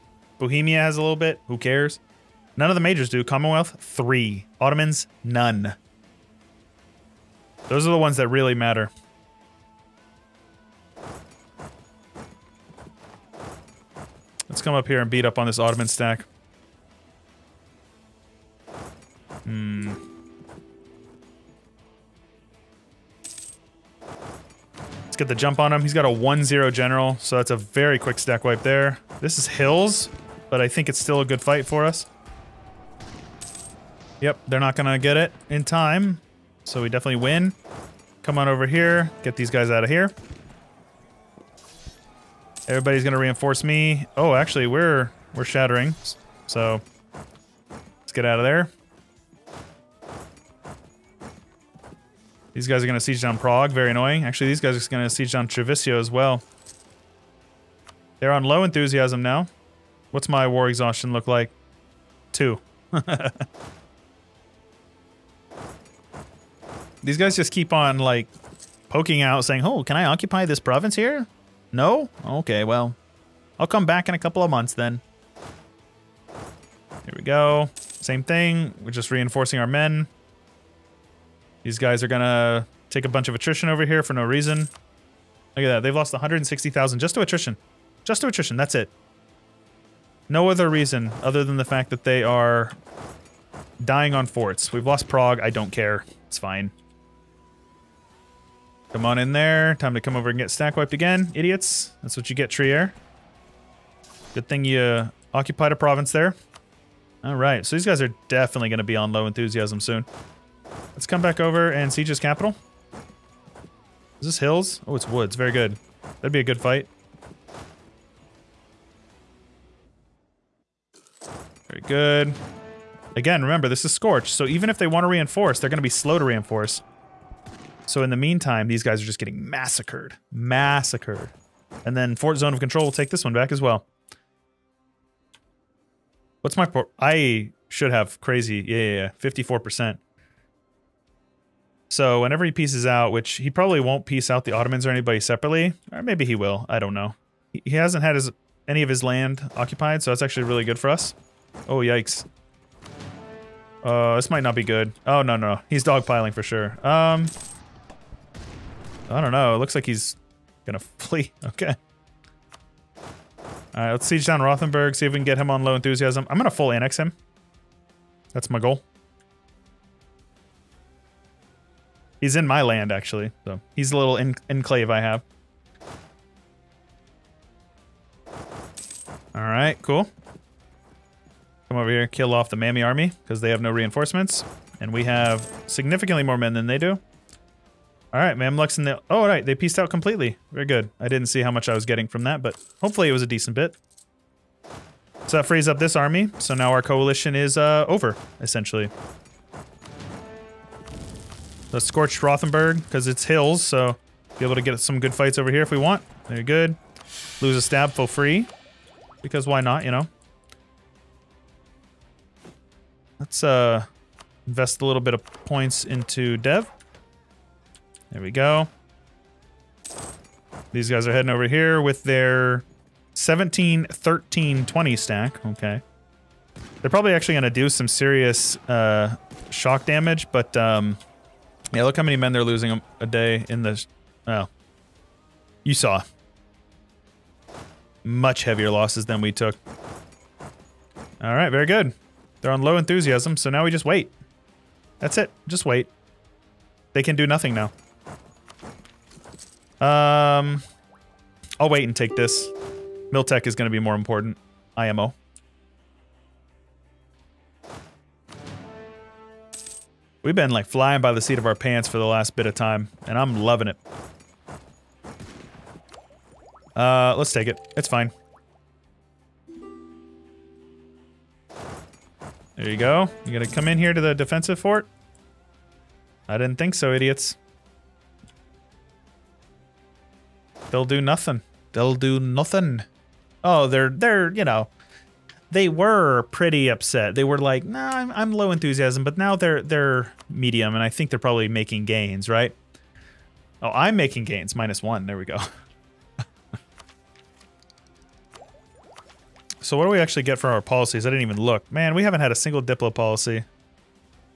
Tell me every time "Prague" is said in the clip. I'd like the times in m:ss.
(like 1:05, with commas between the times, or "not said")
0:53, 1:35.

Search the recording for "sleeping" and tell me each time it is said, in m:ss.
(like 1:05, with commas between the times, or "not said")
not said.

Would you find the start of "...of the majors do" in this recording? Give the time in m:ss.
0:02.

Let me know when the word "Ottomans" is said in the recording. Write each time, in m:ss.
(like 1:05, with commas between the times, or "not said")
0:04, 0:15, 2:24.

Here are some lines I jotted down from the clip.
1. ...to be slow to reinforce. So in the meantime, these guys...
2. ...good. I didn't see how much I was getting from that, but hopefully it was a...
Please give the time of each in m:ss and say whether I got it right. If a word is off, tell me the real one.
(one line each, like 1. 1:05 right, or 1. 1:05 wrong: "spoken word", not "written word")
1. 2:05 right
2. 3:10 right.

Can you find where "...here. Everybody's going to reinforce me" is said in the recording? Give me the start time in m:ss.
0:39.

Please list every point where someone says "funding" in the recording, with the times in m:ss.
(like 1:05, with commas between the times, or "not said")
not said.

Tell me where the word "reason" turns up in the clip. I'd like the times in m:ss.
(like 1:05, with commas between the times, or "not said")
1:24, 1:30.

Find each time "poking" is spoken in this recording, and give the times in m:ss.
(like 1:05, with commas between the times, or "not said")
1:08.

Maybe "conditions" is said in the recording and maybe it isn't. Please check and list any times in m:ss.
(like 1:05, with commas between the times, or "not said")
not said.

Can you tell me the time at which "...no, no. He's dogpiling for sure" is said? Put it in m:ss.
2:35.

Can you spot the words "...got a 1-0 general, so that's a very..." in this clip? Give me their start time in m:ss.
0:25.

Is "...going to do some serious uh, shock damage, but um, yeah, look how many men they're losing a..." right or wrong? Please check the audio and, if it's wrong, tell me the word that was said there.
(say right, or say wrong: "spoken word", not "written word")
right.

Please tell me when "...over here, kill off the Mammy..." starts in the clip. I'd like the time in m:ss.
3:01.